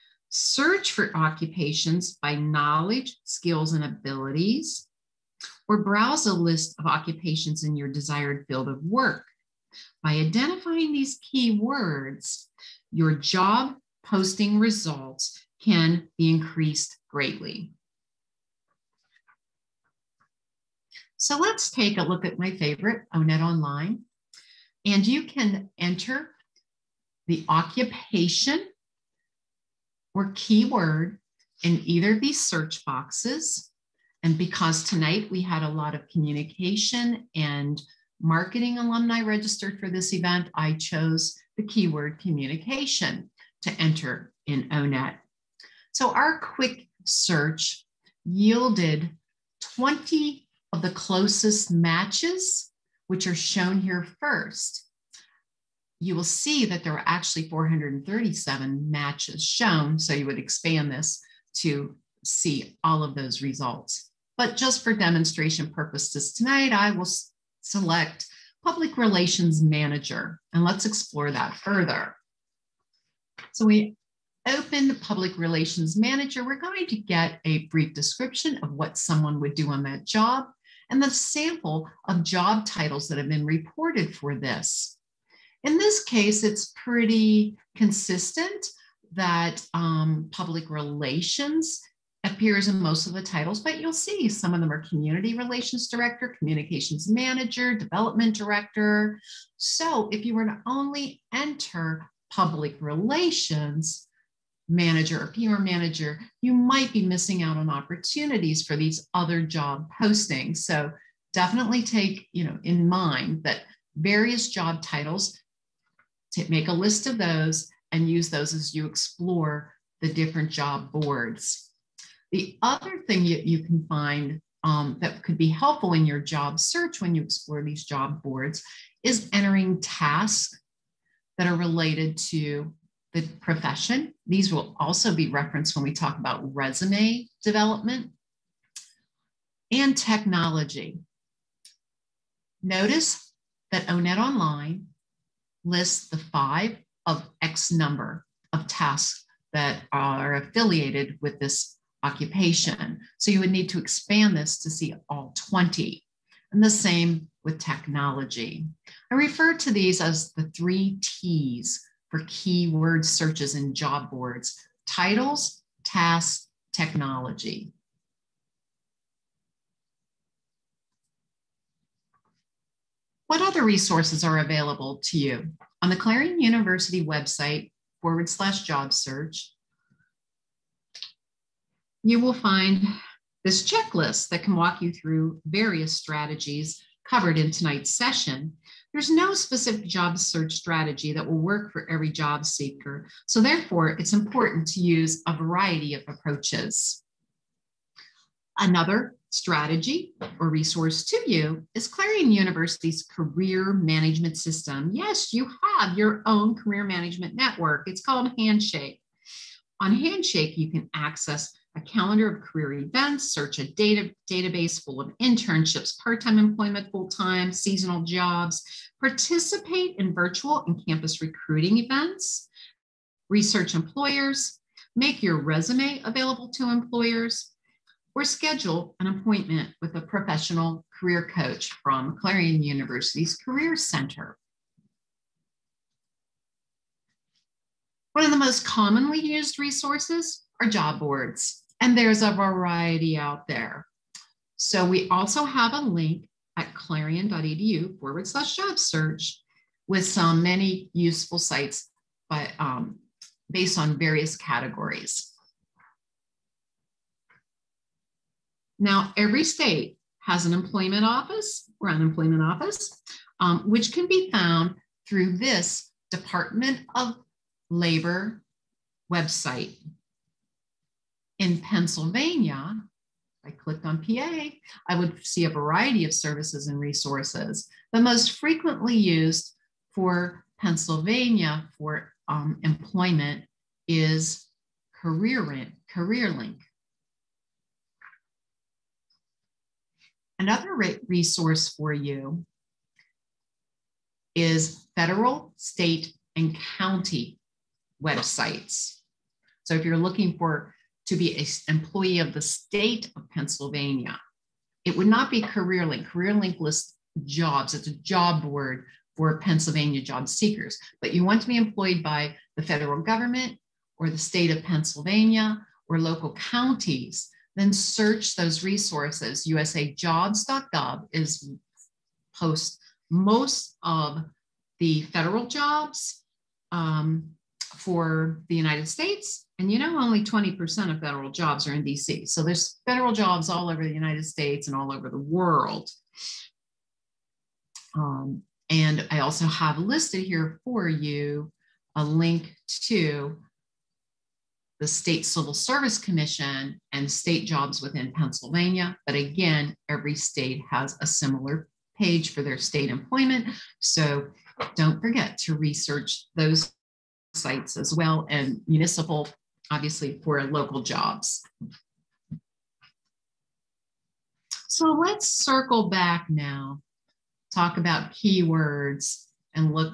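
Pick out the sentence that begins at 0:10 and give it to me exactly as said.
By identifying these keywords, your job posting results can be increased greatly.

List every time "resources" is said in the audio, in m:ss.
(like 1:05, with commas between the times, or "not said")
2:53, 3:20, 3:59, 4:36, 4:51, 5:18.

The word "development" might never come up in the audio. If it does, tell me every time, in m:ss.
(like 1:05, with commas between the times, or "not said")
1:37, 2:17.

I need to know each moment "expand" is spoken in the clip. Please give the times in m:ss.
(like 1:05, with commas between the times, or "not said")
1:00, 2:33.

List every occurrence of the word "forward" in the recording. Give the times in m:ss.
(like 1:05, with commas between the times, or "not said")
2:58, 4:07.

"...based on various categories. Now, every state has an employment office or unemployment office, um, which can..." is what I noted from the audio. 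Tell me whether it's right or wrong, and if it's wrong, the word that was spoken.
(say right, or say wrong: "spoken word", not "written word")
right.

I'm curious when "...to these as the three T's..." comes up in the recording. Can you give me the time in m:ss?
2:39.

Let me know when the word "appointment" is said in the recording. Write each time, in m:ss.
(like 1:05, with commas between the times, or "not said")
3:49.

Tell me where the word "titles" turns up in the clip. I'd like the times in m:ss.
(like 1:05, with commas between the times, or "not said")
1:22, 1:33, 1:54, 2:44.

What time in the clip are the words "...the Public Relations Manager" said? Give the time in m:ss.
1:14.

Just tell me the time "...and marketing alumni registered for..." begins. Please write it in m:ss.
0:37.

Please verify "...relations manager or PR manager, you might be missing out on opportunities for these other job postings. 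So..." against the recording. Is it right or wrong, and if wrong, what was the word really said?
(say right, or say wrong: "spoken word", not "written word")
right.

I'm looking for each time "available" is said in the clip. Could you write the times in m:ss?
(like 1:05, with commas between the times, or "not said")
2:54, 3:46.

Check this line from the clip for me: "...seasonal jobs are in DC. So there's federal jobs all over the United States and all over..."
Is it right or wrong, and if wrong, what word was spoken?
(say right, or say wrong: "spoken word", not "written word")
wrong: "federal", not "seasonal".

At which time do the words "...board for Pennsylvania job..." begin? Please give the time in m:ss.
5:08.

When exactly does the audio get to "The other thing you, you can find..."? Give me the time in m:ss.
2:02.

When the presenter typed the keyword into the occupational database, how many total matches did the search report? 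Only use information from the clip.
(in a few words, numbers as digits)
437.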